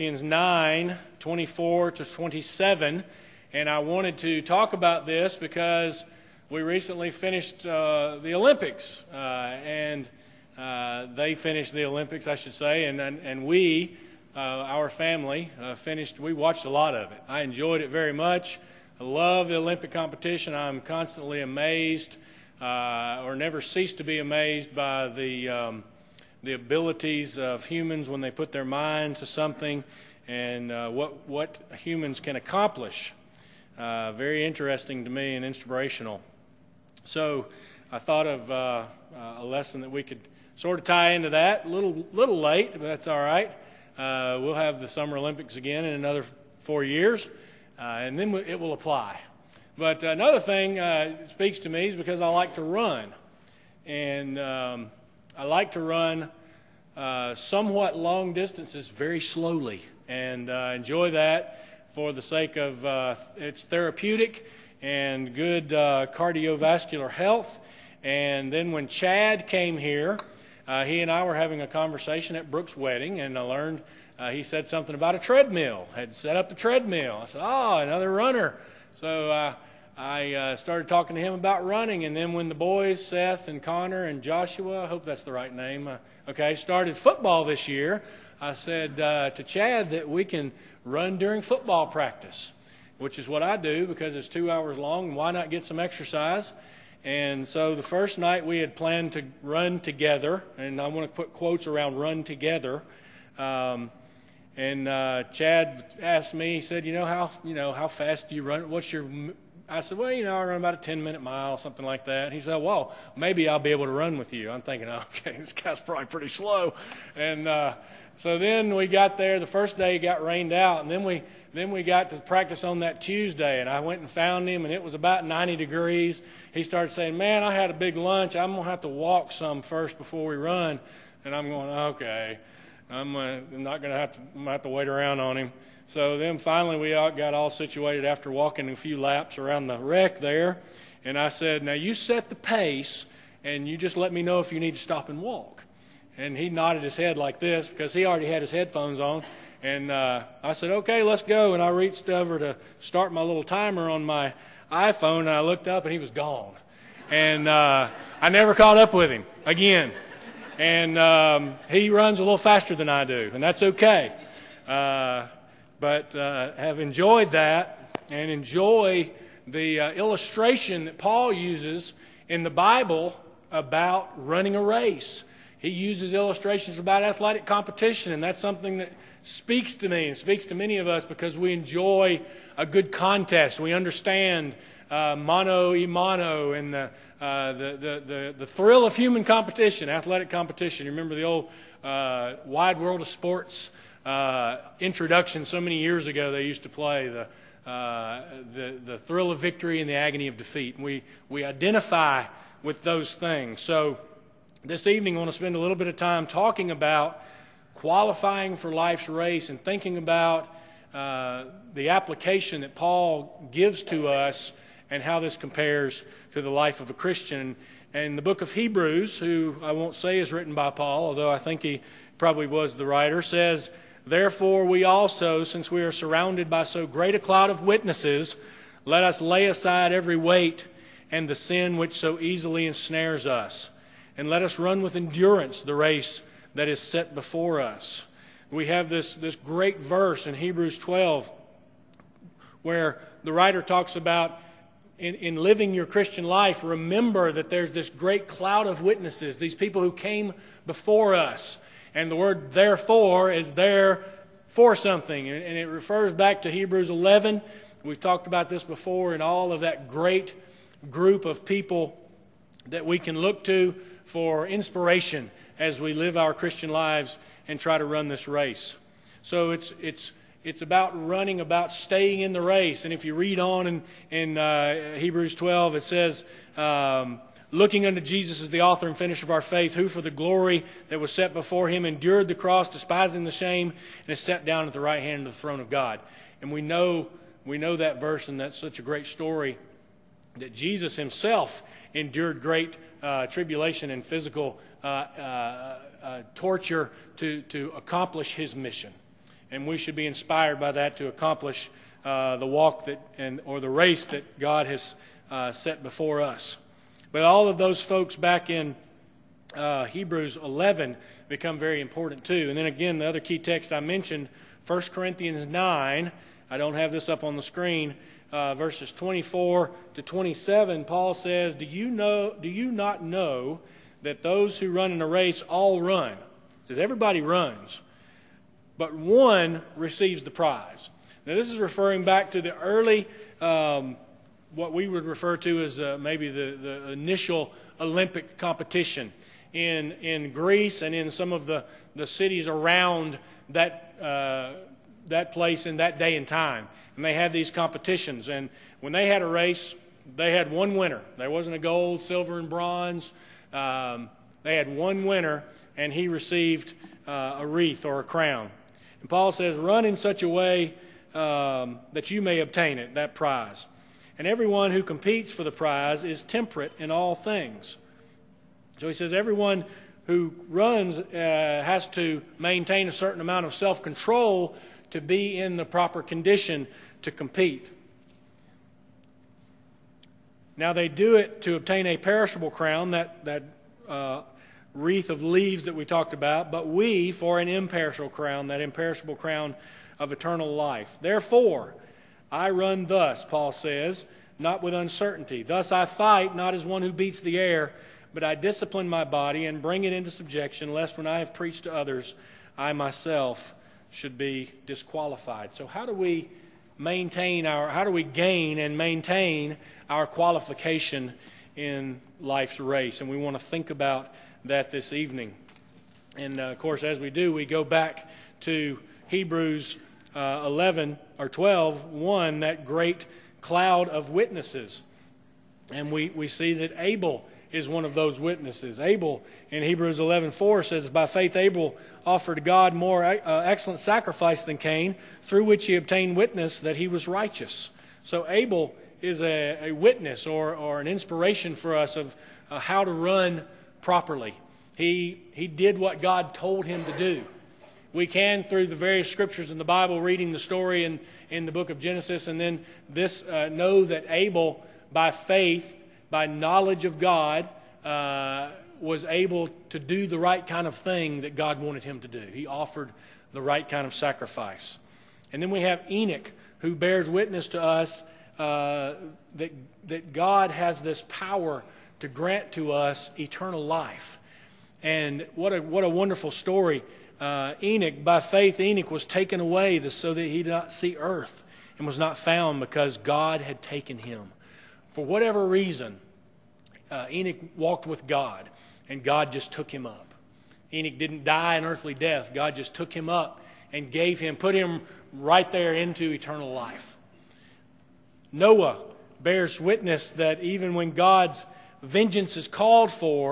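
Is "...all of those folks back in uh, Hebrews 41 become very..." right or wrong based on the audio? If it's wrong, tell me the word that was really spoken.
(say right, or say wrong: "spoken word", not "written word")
wrong: "11", not "41".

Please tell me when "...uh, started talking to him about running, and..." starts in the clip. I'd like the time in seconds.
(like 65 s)
80 s.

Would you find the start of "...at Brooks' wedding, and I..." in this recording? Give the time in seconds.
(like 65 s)
72 s.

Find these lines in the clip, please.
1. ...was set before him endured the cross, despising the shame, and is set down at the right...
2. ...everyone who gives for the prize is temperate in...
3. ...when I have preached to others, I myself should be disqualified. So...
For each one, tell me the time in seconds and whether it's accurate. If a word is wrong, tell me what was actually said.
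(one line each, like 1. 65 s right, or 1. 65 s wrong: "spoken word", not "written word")
1. 280 s right
2. 364 s wrong: "competes", not "gives"
3. 400 s right.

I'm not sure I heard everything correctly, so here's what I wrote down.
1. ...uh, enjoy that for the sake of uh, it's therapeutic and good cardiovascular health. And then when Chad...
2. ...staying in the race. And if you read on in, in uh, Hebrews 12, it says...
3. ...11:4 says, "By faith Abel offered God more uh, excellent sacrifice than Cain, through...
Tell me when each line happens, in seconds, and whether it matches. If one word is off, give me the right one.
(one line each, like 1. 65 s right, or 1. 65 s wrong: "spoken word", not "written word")
1. 60 s right
2. 271 s right
3. 429 s right.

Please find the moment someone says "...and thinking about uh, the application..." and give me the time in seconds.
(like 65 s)
209 s.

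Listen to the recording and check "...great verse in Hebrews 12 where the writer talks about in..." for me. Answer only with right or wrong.
right.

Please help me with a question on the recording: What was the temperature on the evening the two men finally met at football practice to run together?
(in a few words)
90 degrees.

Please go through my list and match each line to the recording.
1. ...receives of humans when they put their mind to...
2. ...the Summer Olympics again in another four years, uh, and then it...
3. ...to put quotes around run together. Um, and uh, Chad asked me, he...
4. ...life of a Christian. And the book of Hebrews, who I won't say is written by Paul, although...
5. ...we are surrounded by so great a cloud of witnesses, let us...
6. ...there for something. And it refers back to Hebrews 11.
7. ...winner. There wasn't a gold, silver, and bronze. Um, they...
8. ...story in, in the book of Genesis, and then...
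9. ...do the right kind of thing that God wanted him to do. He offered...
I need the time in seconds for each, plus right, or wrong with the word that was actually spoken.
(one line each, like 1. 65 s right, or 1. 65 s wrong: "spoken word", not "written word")
1. 26 s wrong: "abilities", not "receives"
2. 44 s right
3. 101 s right
4. 216 s right
5. 225 s right
6. 253 s right
7. 350 s right
8. 450 s right
9. 459 s right.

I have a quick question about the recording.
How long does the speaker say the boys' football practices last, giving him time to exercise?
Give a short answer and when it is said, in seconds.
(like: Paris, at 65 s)
2 hours, at 94 s.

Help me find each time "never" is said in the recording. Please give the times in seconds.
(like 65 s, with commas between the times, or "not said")
23 s, 158 s.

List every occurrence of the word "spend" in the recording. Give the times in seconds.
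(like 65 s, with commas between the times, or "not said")
205 s.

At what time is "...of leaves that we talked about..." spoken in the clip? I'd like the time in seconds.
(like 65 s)
385 s.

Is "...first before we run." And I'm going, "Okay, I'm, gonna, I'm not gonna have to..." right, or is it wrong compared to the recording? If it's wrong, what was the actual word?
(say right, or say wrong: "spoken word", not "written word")
right.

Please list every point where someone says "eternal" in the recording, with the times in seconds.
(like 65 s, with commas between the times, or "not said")
390 s, 473 s, 496 s.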